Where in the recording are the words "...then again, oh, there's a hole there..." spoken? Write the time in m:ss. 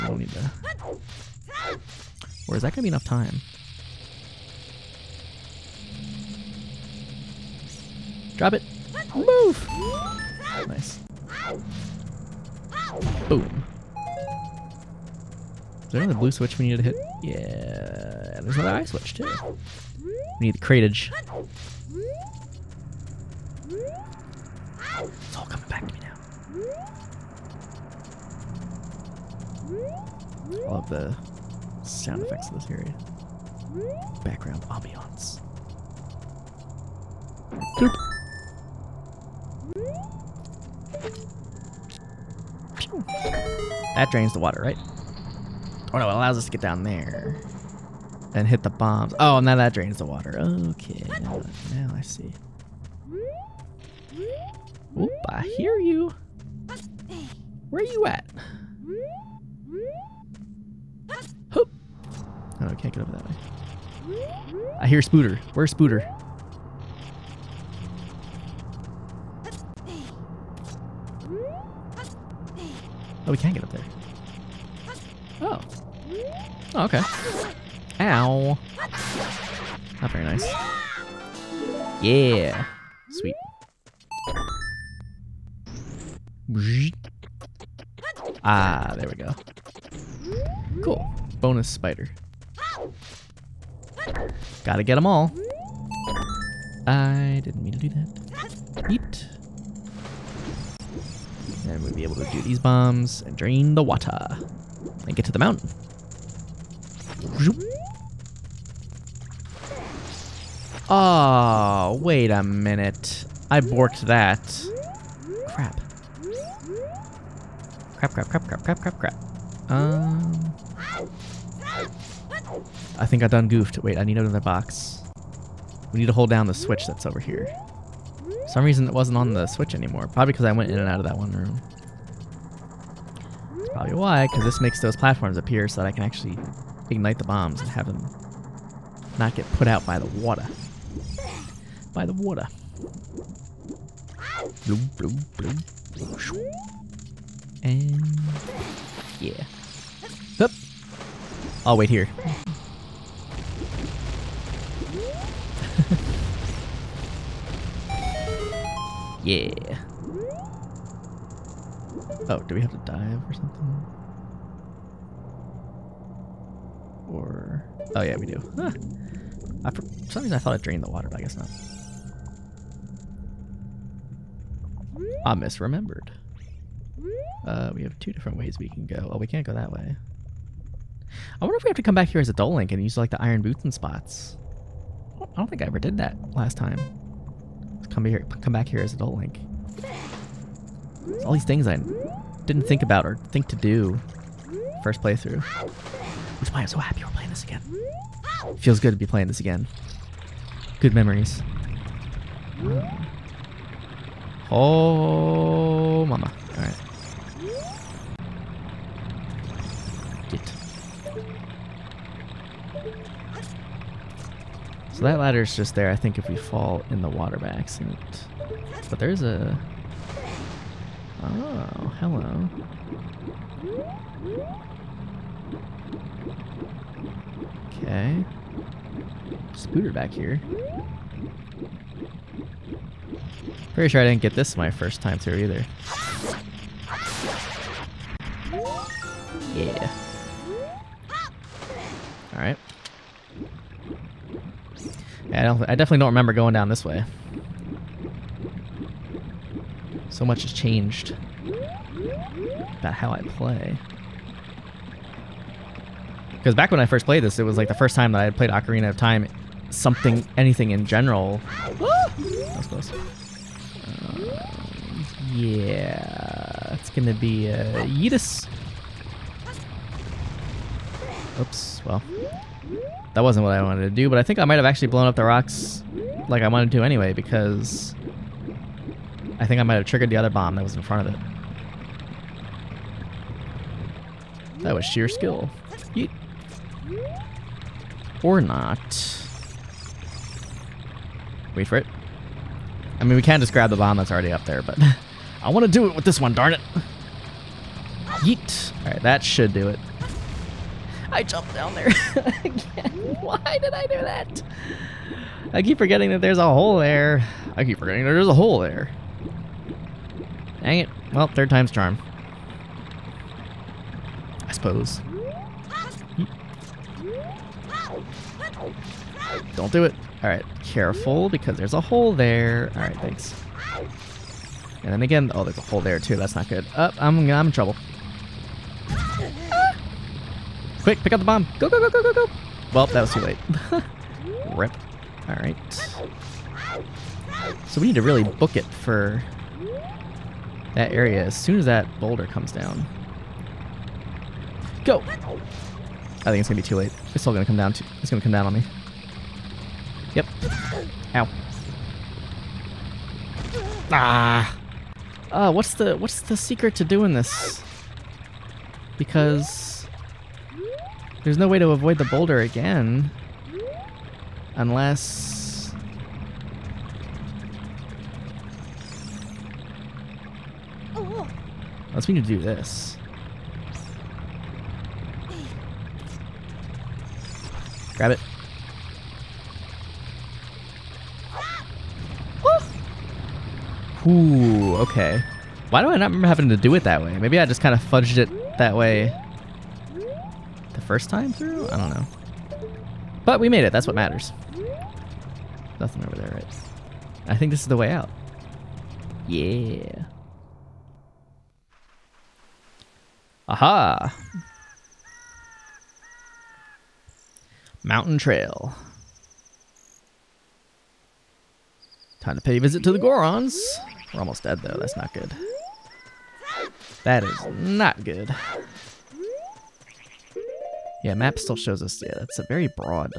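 5:24.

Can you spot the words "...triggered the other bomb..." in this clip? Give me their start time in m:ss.
4:39.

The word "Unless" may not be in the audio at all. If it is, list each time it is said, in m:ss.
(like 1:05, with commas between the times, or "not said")
6:04, 6:10.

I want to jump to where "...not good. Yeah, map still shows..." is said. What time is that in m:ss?
6:57.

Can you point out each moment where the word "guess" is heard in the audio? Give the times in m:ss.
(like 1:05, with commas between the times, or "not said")
2:51.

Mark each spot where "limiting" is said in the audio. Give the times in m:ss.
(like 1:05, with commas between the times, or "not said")
not said.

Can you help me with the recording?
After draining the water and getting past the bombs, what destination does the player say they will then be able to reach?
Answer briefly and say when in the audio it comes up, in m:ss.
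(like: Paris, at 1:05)
The mountain, at 1:45.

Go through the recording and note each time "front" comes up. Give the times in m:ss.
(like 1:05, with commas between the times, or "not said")
4:40.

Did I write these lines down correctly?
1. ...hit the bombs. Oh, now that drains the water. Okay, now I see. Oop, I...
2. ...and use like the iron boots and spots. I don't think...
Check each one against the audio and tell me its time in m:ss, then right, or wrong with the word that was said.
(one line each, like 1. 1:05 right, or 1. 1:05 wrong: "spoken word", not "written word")
1. 0:48 right
2. 3:02 right.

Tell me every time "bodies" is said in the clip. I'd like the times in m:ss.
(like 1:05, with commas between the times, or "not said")
not said.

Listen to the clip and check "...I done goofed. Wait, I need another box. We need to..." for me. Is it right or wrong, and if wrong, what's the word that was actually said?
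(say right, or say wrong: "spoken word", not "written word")
right.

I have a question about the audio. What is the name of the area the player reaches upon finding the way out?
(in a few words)
Mountain Trail.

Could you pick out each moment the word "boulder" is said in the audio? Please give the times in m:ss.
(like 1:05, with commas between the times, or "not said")
5:42, 6:02.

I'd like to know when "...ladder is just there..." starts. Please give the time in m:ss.
3:35.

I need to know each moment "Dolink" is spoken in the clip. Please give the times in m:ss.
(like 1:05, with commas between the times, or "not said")
3:02, 3:08.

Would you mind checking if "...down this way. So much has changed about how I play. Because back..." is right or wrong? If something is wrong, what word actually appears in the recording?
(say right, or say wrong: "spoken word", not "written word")
right.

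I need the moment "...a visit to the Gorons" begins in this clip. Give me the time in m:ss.
6:52.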